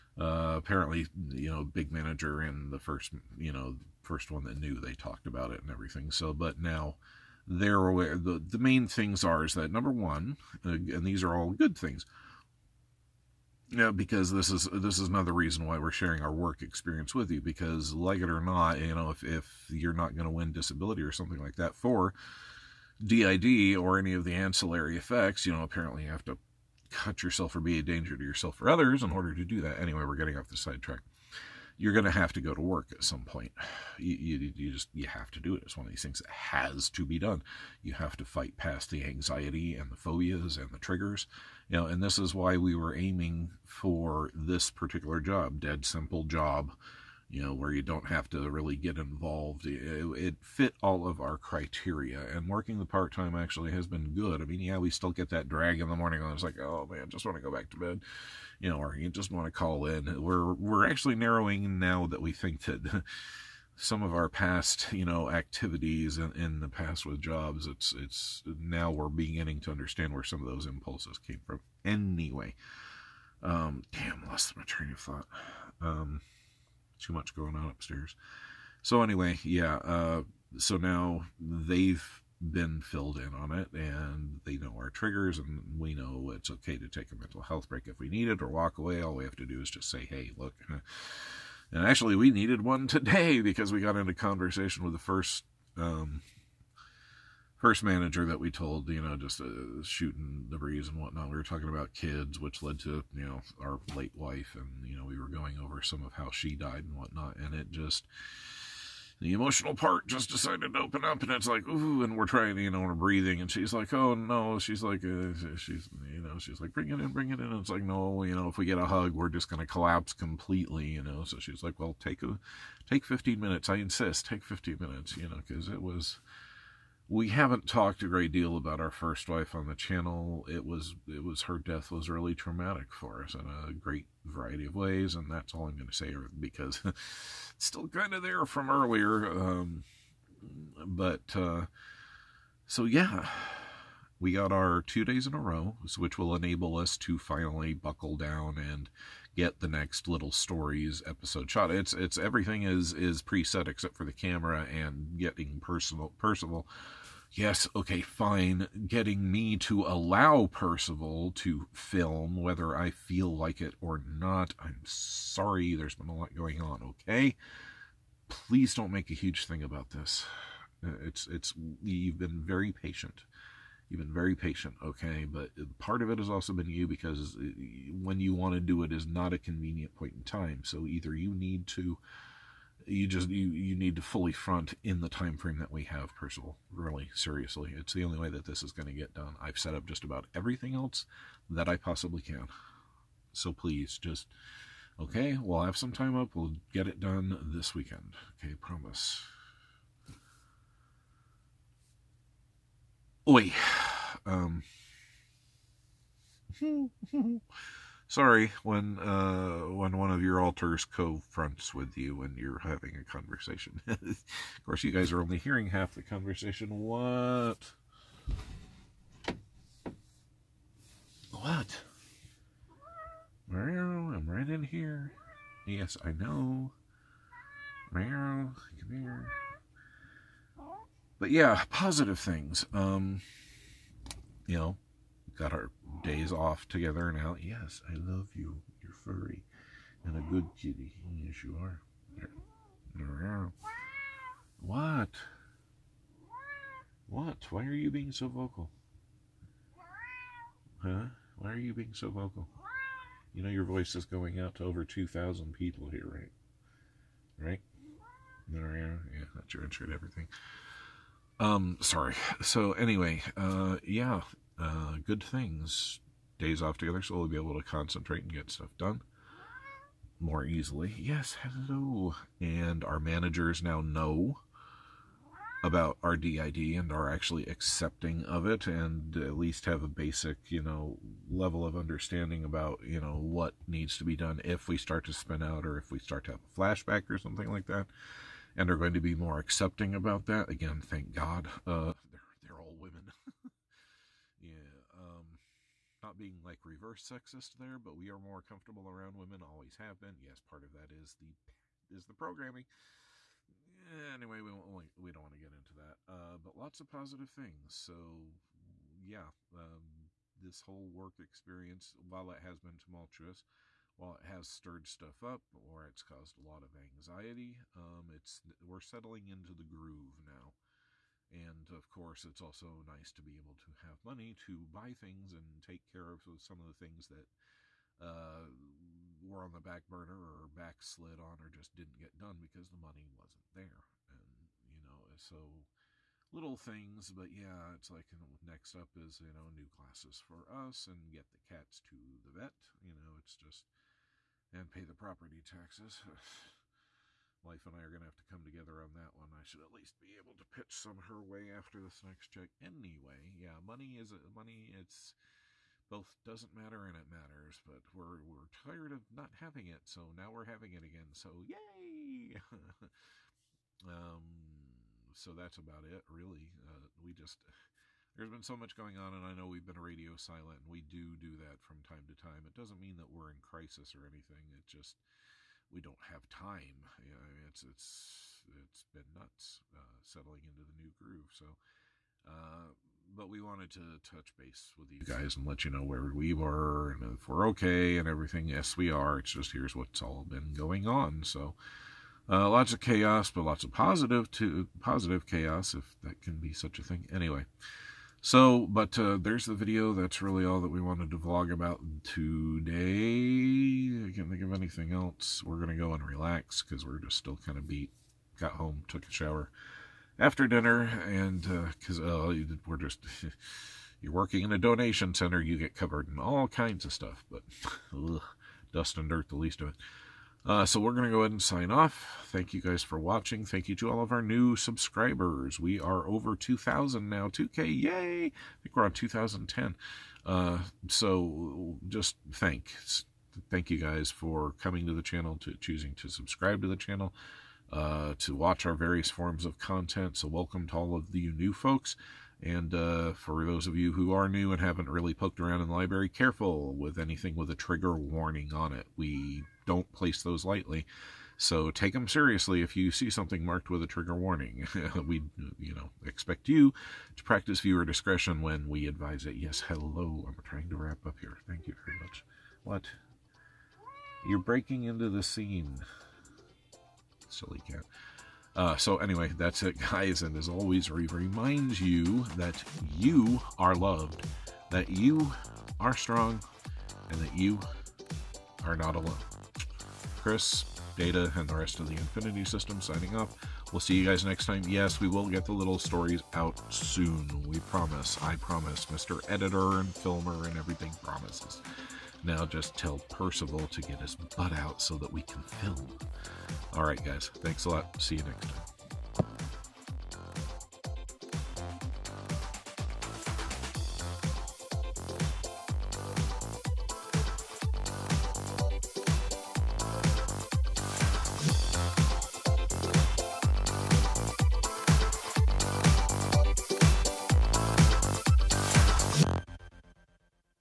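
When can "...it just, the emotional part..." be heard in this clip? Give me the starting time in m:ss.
1:47.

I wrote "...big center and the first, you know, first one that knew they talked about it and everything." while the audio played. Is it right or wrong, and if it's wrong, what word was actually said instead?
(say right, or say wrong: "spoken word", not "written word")
wrong: "manager", not "center".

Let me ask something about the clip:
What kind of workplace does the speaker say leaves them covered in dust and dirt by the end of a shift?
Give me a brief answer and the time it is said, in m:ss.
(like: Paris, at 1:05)
donation center, at 6:54.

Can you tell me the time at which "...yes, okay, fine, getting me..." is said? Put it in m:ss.
2:37.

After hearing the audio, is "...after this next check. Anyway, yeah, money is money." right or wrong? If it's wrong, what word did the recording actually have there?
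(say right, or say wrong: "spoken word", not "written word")
right.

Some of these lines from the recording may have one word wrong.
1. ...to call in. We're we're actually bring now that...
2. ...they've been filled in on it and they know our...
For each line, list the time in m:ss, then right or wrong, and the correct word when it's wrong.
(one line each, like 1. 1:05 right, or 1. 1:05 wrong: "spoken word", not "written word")
1. 0:59 wrong: "narrowing", not "bring"
2. 1:21 right.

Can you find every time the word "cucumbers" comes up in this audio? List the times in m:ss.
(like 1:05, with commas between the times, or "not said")
not said.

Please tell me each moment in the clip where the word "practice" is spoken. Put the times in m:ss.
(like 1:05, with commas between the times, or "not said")
7:37.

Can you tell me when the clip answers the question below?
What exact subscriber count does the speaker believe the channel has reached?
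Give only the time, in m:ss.
7:08.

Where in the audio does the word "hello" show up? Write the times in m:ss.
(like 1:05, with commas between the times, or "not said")
4:31, 7:39.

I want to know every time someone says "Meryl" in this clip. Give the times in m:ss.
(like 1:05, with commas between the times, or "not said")
3:43, 3:47.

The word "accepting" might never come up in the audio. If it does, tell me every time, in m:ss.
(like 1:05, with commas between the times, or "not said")
4:37, 4:49.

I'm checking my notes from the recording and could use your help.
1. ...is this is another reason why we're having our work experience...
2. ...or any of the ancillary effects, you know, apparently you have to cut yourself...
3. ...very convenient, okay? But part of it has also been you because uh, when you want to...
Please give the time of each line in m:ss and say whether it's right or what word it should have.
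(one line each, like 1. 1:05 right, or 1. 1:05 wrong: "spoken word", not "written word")
1. 0:14 wrong: "sharing", not "having"
2. 0:23 right
3. 2:54 wrong: "patient", not "convenient".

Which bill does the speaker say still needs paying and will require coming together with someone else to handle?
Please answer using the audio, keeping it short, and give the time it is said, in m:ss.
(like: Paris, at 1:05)
property taxes, at 5:44.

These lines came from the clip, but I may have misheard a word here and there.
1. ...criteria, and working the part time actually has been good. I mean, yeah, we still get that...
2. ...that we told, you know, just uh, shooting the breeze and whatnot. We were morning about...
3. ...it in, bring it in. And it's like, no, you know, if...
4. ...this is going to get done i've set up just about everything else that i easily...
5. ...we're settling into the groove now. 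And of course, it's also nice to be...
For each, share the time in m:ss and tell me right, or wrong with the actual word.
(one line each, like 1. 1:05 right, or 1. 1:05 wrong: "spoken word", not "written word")
1. 0:51 right
2. 1:38 wrong: "talking", not "morning"
3. 1:56 right
4. 3:08 wrong: "possibly", not "easily"
5. 5:18 right.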